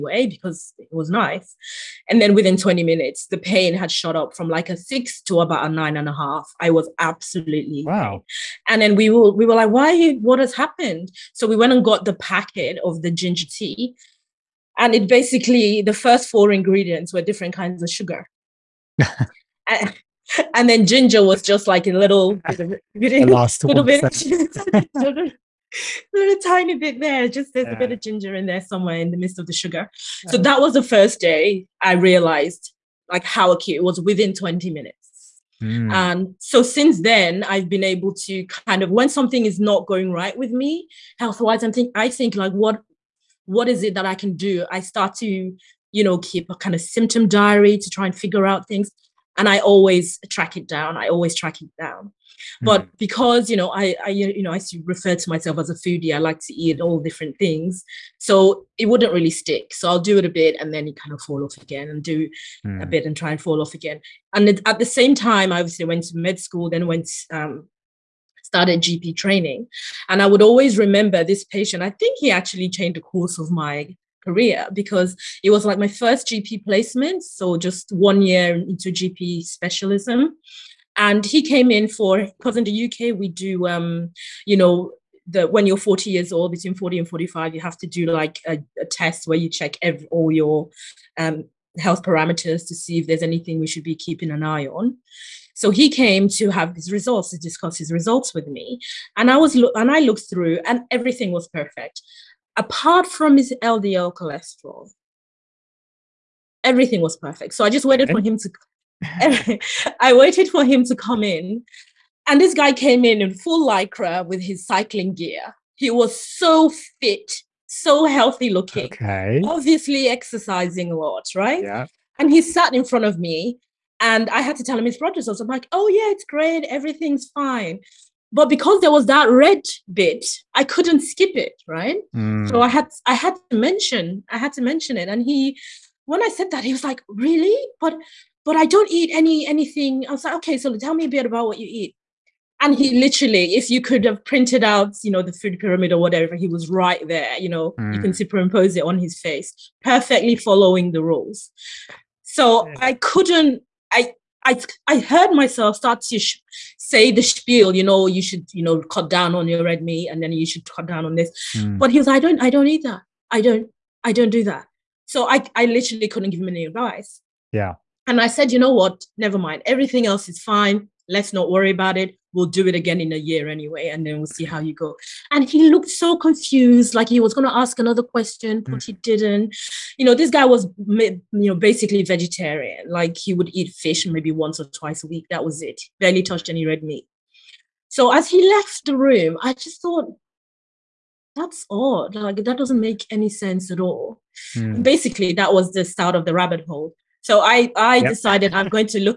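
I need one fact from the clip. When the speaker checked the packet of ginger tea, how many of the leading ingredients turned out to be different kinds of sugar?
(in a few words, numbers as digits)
4.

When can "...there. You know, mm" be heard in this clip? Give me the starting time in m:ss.
2:27.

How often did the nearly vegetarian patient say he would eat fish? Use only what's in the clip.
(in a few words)
once or twice a week.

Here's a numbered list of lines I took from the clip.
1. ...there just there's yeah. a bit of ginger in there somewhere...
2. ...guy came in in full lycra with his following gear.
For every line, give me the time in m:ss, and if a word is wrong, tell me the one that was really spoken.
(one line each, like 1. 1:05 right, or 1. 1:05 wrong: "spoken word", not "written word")
1. 0:26 right
2. 1:52 wrong: "cycling", not "following".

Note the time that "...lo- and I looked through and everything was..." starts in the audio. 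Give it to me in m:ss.
1:39.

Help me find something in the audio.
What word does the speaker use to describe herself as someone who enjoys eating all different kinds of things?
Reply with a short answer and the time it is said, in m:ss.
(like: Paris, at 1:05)
foodie, at 0:55.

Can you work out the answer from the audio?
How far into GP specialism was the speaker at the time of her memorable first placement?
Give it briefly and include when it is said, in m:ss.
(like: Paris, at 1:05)
one year, at 1:17.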